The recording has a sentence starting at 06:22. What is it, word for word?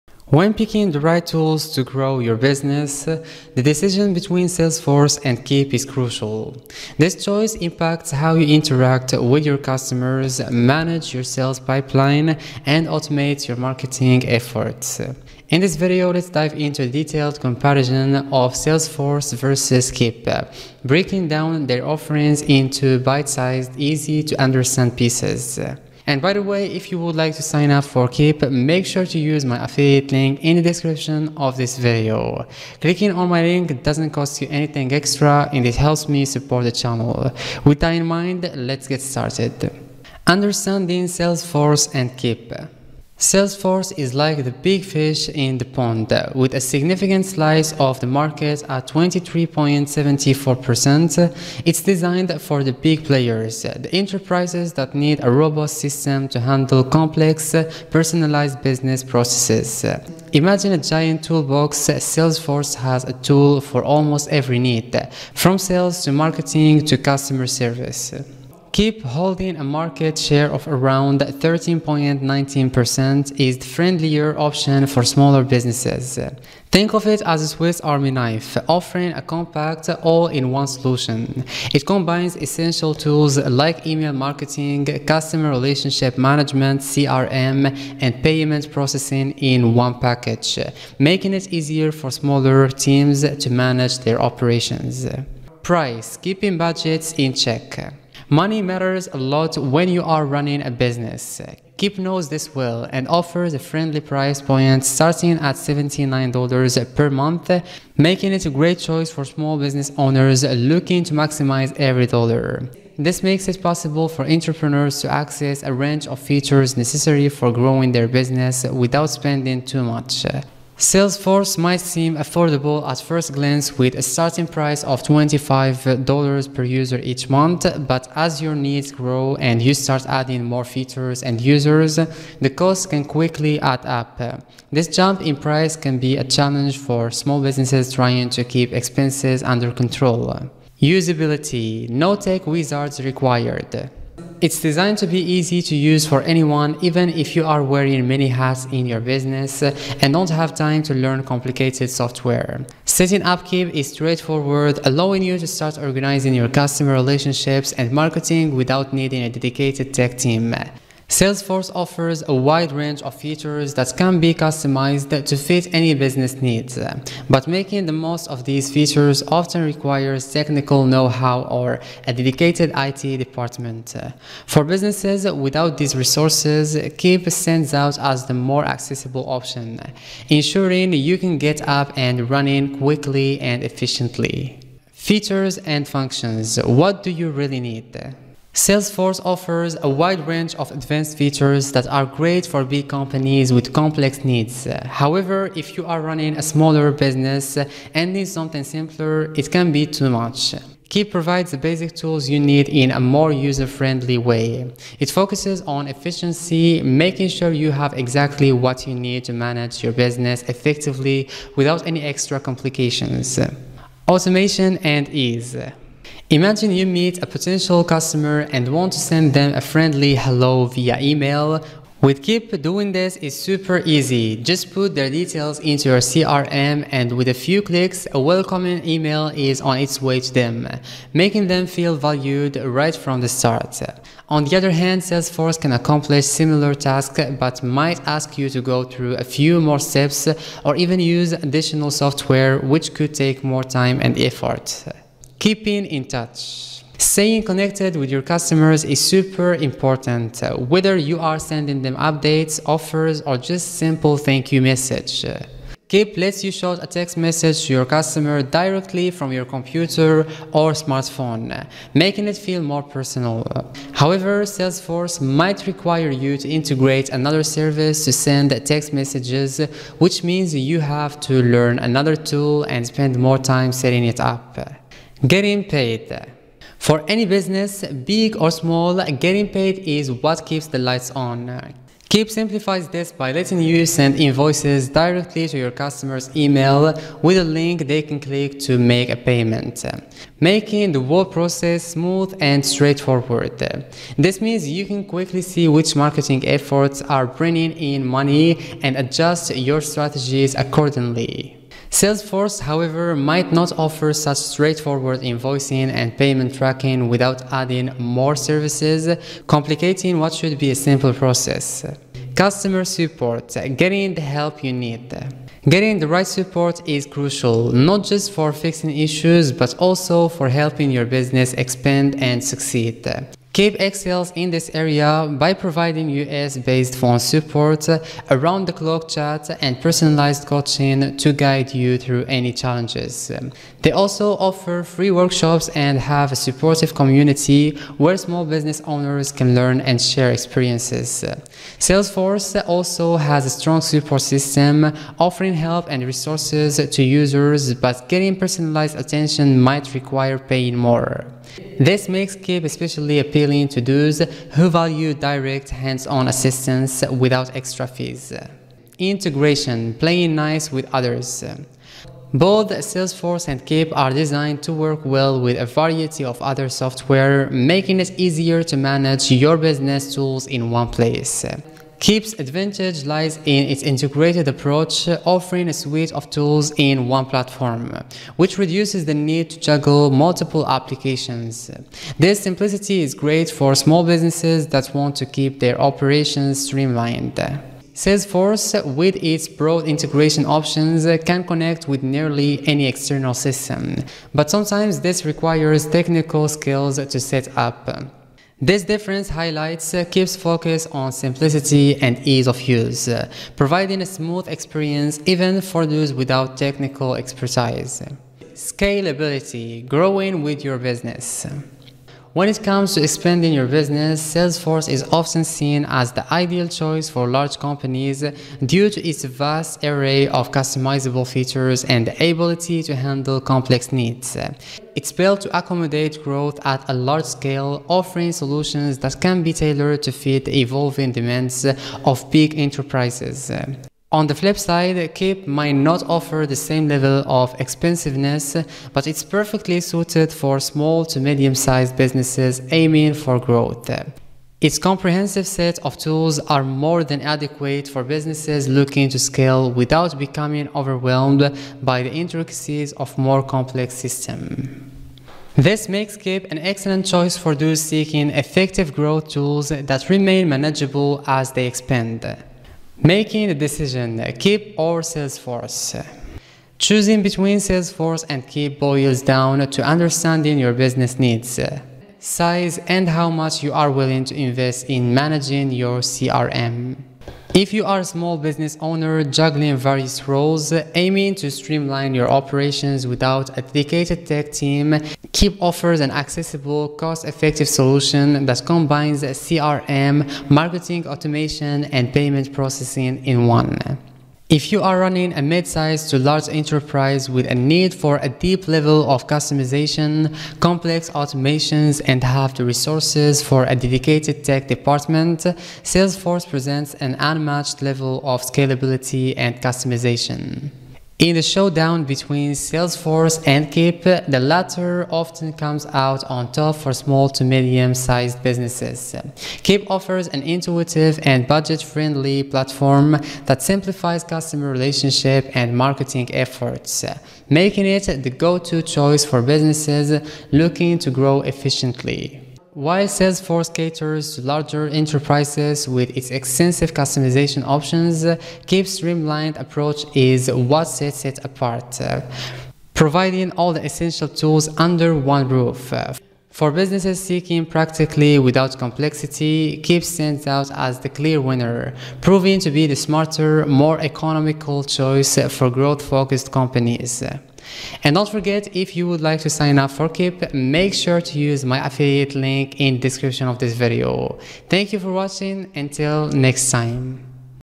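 This simplicity is great for small businesses that want to keep their operations streamlined.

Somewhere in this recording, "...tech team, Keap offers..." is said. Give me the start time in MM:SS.
08:04.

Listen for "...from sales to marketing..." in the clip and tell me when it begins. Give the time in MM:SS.
01:05.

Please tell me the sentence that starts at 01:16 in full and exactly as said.
Think of it as a Swiss army knife, offering a compact all-in-one solution.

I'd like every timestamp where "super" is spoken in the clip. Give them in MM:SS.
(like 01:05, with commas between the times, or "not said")
03:43, 04:09.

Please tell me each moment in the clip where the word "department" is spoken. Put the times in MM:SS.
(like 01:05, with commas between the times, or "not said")
02:53, 08:24.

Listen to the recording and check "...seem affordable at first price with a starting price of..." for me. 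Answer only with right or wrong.
wrong.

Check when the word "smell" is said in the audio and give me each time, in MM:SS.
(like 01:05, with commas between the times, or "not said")
not said.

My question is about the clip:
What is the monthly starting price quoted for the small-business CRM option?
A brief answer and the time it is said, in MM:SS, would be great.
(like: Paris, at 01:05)
$79, at 01:45.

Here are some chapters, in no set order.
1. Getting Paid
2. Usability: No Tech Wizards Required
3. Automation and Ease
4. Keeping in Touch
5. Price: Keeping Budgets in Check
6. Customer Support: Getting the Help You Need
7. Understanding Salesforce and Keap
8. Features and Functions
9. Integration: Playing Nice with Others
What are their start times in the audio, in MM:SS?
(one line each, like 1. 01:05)
1. 04:34
2. 02:20
3. 03:33
4. 04:05
5. 01:35
6. 05:12
7. 00:39
8. 03:04
9. 05:58.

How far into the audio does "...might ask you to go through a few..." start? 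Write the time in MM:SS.
03:57.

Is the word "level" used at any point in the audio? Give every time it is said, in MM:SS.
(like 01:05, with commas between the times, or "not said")
07:16, 08:18, 08:27.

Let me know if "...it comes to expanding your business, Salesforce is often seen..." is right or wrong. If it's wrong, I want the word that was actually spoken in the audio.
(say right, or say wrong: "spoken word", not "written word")
right.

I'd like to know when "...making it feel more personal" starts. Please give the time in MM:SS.
04:21.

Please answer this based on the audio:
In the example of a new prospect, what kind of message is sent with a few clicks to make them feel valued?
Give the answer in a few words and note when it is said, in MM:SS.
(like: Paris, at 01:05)
welcoming email, at 03:48.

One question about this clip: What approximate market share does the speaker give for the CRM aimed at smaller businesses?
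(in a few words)
13.19%.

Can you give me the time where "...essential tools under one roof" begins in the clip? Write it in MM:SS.
09:03.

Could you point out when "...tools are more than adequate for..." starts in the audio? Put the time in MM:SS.
07:25.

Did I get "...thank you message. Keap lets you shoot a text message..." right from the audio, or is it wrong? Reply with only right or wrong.
right.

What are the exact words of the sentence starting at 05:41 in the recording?
Salesforce also has a strong support system, offering help and resources to users, but getting personalized attention might require paying more.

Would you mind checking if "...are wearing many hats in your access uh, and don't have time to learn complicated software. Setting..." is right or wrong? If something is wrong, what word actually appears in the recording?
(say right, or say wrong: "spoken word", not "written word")
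wrong: "business", not "access".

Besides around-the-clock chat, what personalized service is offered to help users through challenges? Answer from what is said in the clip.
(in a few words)
personalized coaching.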